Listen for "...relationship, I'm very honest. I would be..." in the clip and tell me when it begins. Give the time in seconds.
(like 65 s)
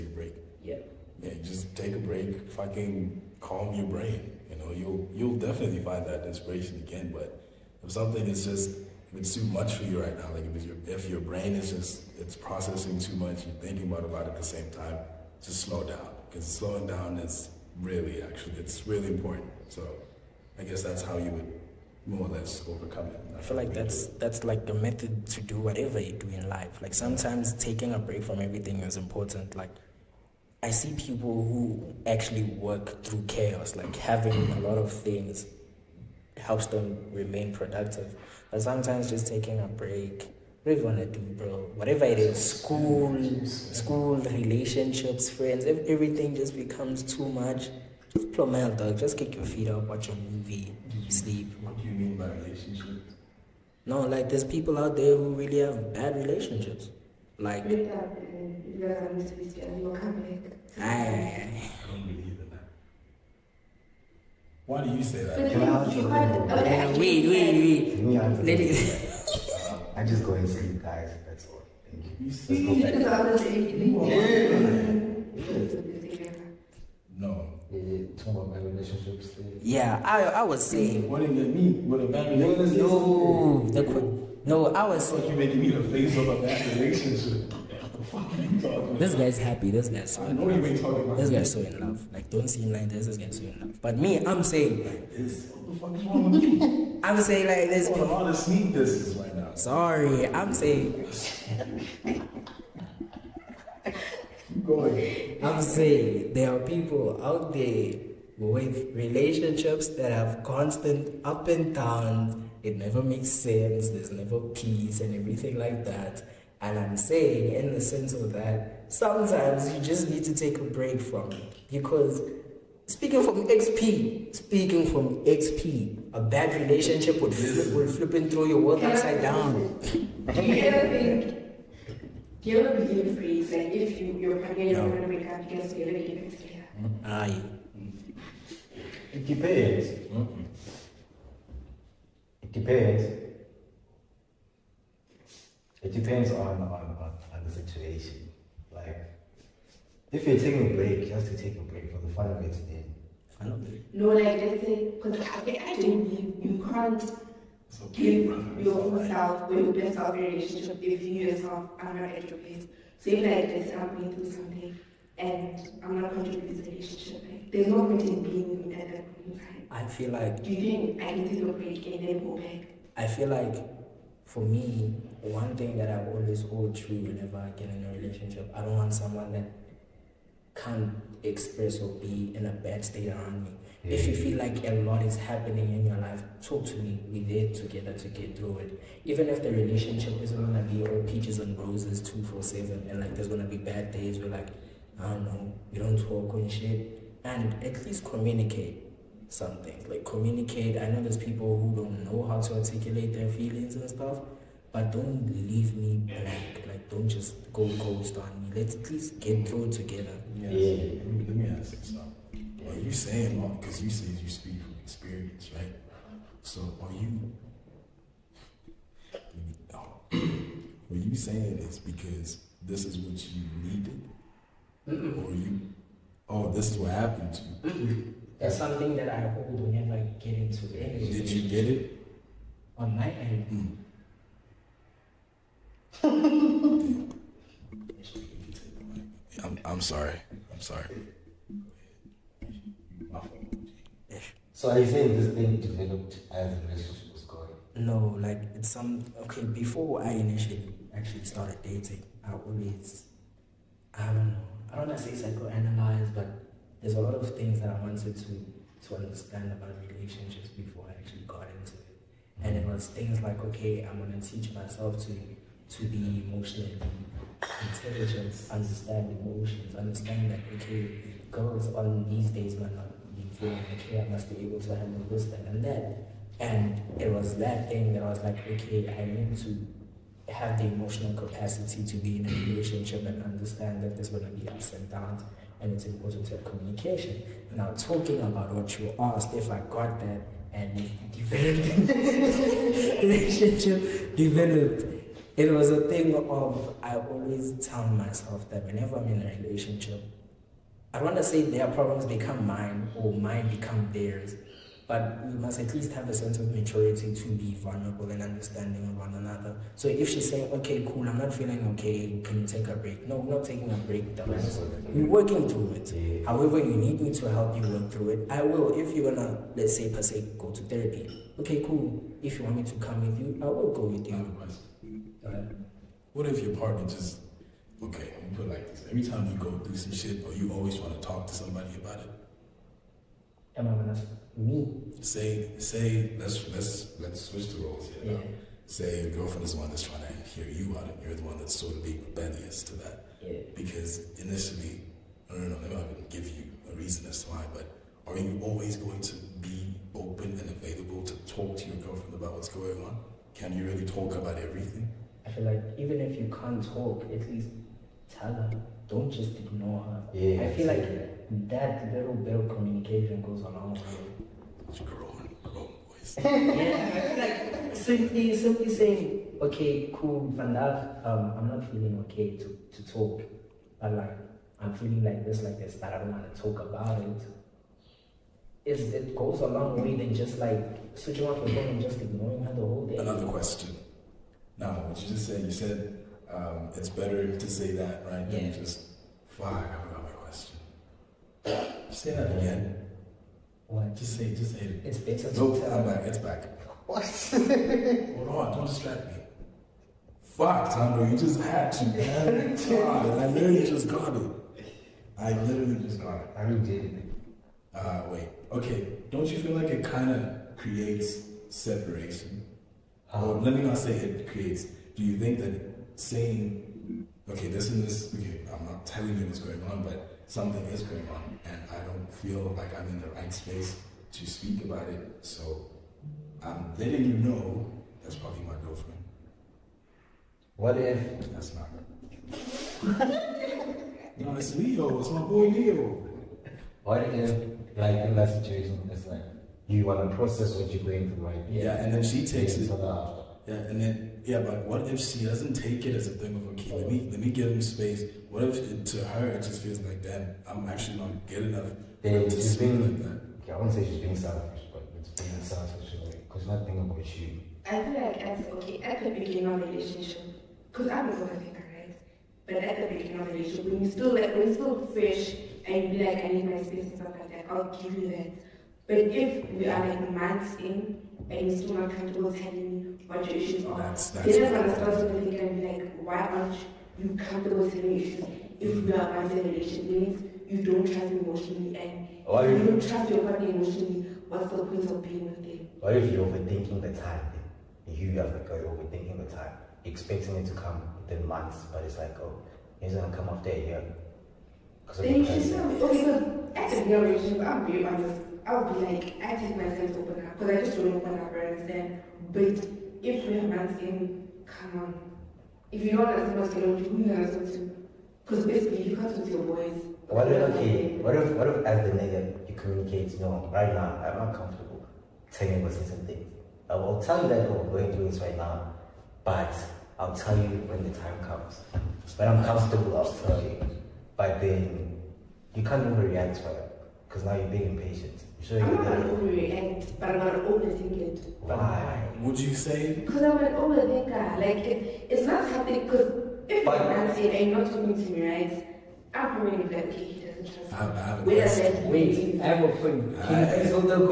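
496 s.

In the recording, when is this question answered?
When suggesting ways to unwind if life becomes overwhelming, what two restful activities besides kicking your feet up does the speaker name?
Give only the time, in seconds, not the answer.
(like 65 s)
49 s.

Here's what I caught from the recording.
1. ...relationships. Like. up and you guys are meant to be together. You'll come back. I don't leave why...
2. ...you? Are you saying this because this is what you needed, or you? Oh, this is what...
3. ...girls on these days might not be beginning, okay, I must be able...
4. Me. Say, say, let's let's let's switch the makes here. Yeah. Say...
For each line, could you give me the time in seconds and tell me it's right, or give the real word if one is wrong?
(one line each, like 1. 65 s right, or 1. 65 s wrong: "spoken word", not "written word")
1. 56 s wrong: "believe", not "leave"
2. 216 s right
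3. 271 s wrong: "feeling", not "beginning"
4. 334 s wrong: "roles", not "makes".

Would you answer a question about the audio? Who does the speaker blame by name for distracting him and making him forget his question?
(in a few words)
Thando.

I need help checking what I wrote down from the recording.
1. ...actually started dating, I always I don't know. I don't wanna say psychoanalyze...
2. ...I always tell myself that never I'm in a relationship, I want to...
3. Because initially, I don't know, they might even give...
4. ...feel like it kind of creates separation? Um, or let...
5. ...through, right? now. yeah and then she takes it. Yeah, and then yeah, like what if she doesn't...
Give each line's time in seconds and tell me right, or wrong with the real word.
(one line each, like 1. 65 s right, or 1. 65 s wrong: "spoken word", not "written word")
1. 250 s right
2. 296 s wrong: "whenever", not "never"
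3. 343 s right
4. 409 s right
5. 441 s right.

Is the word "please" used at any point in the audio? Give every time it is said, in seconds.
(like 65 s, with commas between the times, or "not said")
543 s.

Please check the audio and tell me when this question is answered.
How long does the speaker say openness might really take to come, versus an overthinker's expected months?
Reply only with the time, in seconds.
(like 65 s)
493 s.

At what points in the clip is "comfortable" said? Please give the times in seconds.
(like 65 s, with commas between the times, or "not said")
471 s, 477 s, 514 s, 522 s.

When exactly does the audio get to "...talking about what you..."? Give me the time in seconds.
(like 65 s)
287 s.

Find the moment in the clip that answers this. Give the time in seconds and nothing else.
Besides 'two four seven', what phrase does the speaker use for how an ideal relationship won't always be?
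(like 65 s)
191 s.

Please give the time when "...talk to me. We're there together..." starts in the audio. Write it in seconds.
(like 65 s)
186 s.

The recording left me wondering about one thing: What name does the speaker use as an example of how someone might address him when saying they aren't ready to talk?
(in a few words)
Van Dijk.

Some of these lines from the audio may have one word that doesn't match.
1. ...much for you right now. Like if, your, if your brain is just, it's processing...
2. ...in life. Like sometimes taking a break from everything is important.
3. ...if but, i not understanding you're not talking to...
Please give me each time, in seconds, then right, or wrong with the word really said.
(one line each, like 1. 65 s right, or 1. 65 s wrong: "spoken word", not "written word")
1. 9 s right
2. 26 s right
3. 536 s wrong: "saying", not "understanding".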